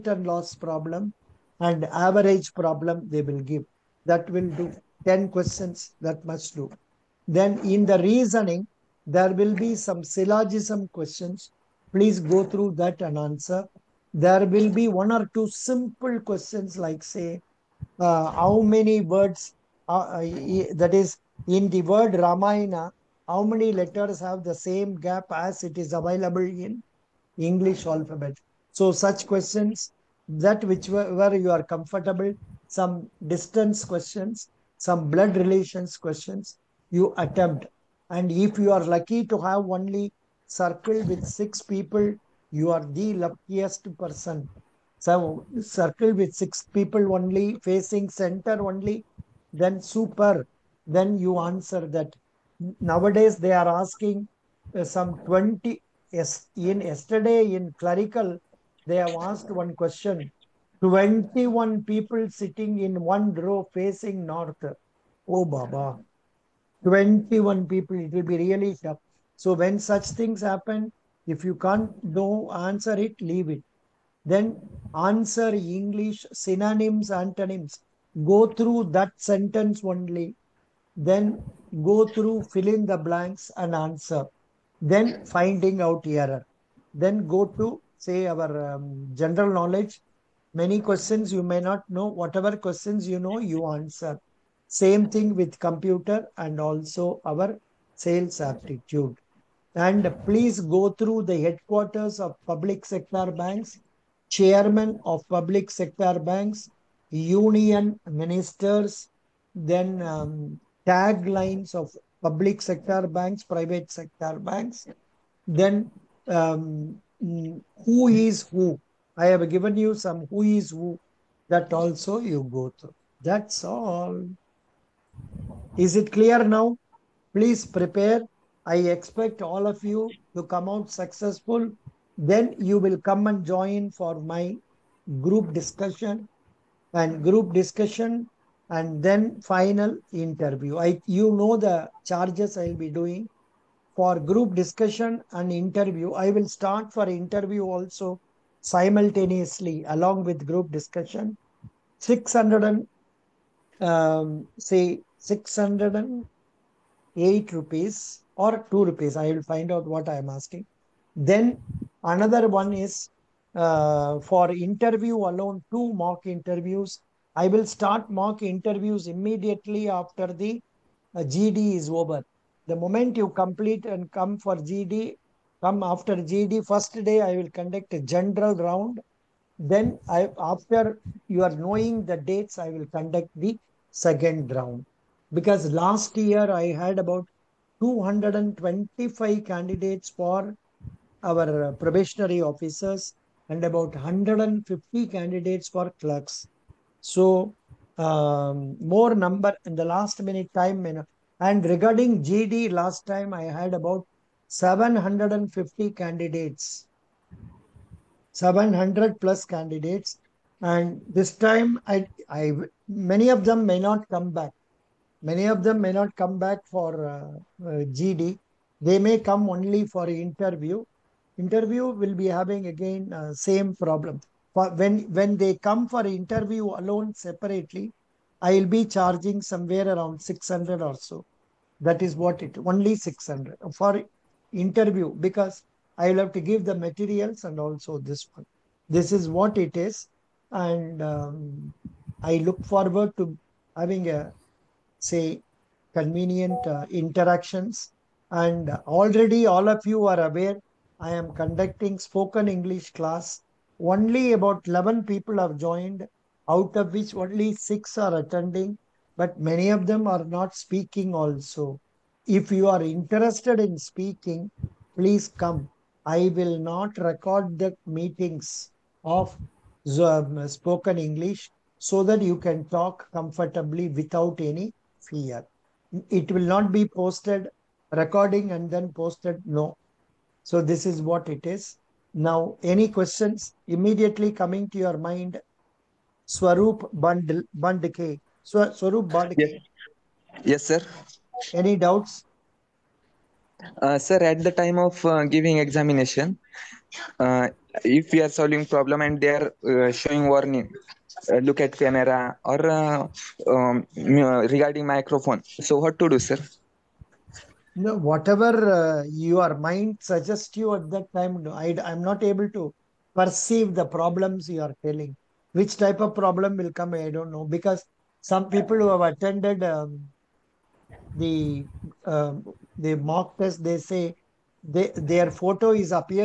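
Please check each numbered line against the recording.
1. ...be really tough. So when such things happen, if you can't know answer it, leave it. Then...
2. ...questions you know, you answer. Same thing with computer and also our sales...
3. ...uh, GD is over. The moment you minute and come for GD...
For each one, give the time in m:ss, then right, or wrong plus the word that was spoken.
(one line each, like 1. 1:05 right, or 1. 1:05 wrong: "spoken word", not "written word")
1. 1:08 right
2. 1:32 right
3. 2:51 wrong: "complete", not "minute".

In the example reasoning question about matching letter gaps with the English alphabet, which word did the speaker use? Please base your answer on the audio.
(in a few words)
Ramayana.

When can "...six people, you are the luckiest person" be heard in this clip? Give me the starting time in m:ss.
0:41.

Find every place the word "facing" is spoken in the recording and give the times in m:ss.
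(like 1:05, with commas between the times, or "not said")
0:47, 1:03.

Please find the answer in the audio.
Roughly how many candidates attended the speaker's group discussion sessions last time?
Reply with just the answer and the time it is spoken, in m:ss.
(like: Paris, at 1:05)
750, at 3:24.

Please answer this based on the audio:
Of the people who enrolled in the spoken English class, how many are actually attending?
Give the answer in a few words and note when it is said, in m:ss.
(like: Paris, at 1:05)
6, at 4:17.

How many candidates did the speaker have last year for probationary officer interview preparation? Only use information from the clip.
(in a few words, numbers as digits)
225.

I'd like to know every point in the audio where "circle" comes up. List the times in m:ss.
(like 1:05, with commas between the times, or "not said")
0:40, 0:45.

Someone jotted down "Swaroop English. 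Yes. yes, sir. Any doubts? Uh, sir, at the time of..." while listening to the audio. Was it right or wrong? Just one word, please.
wrong.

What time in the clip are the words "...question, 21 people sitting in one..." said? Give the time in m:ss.
0:59.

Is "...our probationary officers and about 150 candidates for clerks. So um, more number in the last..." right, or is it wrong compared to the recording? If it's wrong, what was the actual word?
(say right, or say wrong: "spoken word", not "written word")
right.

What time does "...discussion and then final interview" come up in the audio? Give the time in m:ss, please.
2:17.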